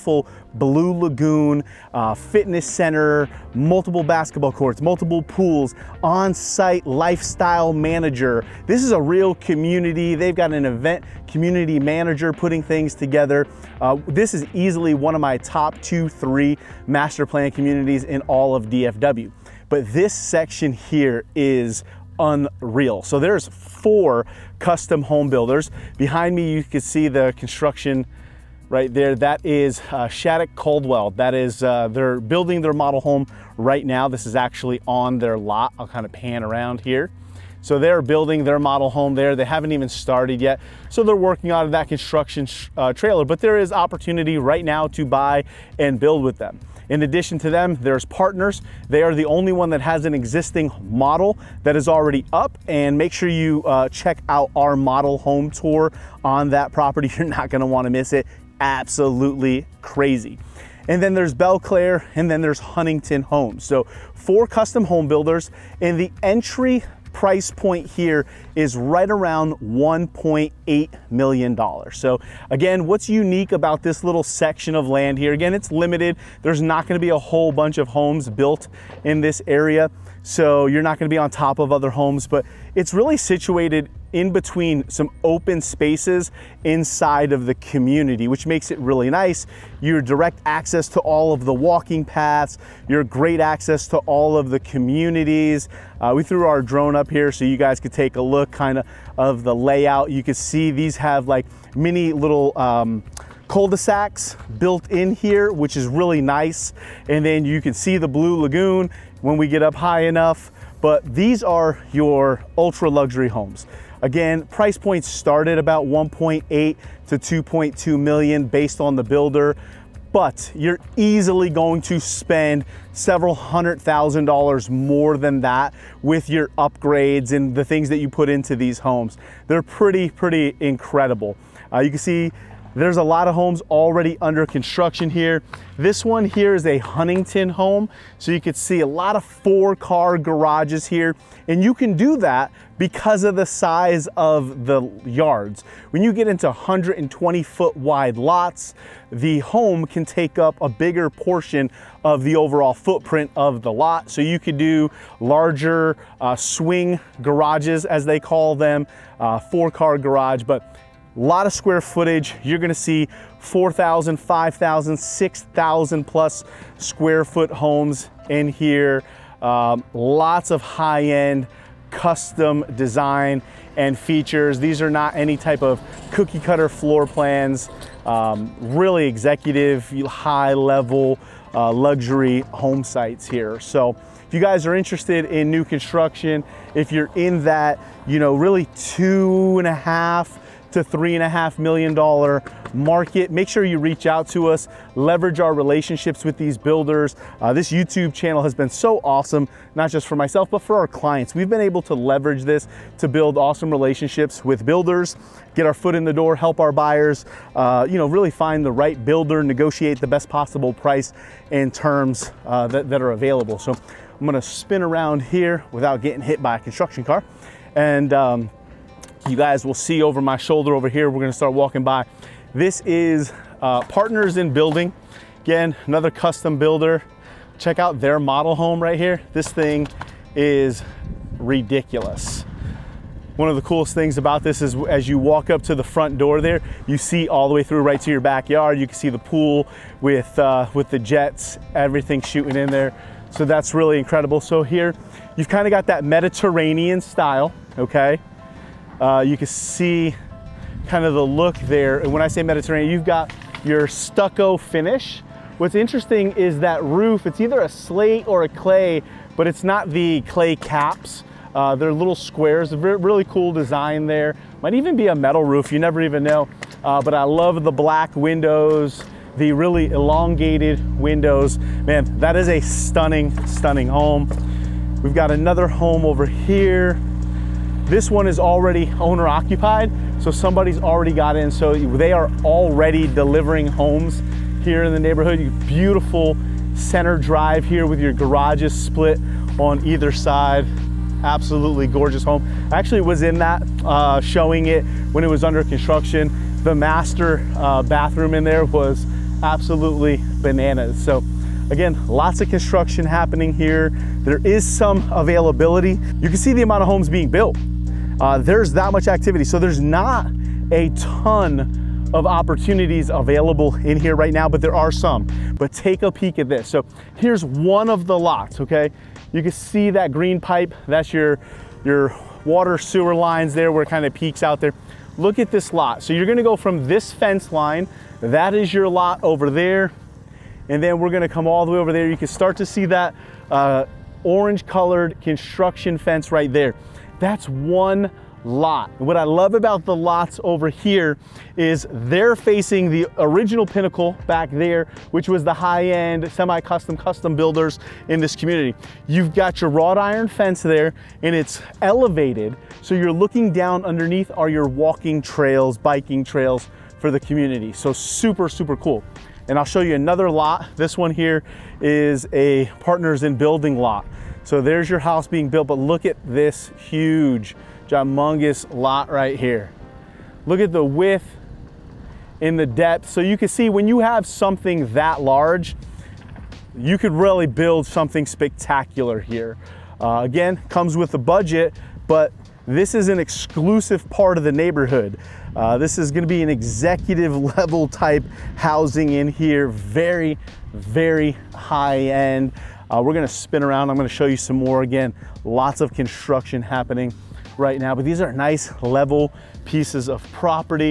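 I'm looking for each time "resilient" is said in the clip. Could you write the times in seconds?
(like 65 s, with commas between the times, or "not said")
not said.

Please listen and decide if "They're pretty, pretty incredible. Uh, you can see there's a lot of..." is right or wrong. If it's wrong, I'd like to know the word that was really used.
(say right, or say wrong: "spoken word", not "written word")
right.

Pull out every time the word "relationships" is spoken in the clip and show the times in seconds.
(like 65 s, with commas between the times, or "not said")
195 s, 203 s.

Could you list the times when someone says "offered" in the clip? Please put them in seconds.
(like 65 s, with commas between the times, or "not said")
not said.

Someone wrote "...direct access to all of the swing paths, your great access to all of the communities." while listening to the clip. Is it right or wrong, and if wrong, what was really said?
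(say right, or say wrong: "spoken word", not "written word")
wrong: "walking", not "swing".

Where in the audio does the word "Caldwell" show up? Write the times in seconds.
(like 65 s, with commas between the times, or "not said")
30 s.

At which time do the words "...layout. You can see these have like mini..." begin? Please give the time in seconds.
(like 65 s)
99 s.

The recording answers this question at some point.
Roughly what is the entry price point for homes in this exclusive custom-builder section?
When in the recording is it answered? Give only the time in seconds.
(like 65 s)
69 s.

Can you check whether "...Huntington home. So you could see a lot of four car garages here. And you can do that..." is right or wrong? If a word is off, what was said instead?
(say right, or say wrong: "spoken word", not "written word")
right.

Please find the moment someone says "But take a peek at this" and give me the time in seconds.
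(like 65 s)
315 s.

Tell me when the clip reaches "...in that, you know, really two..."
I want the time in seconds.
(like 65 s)
187 s.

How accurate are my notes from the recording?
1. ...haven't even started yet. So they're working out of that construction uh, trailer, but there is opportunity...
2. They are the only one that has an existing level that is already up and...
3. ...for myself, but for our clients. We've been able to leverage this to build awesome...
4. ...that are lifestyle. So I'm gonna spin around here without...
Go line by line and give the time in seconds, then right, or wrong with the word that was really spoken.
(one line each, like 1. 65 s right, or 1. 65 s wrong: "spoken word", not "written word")
1. 39 s right
2. 48 s wrong: "model", not "level"
3. 200 s right
4. 212 s wrong: "available", not "lifestyle".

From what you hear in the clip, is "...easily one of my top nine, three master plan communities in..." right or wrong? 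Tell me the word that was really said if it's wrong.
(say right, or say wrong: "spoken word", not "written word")
wrong: "two", not "nine".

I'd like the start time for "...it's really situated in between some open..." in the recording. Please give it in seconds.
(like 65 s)
82 s.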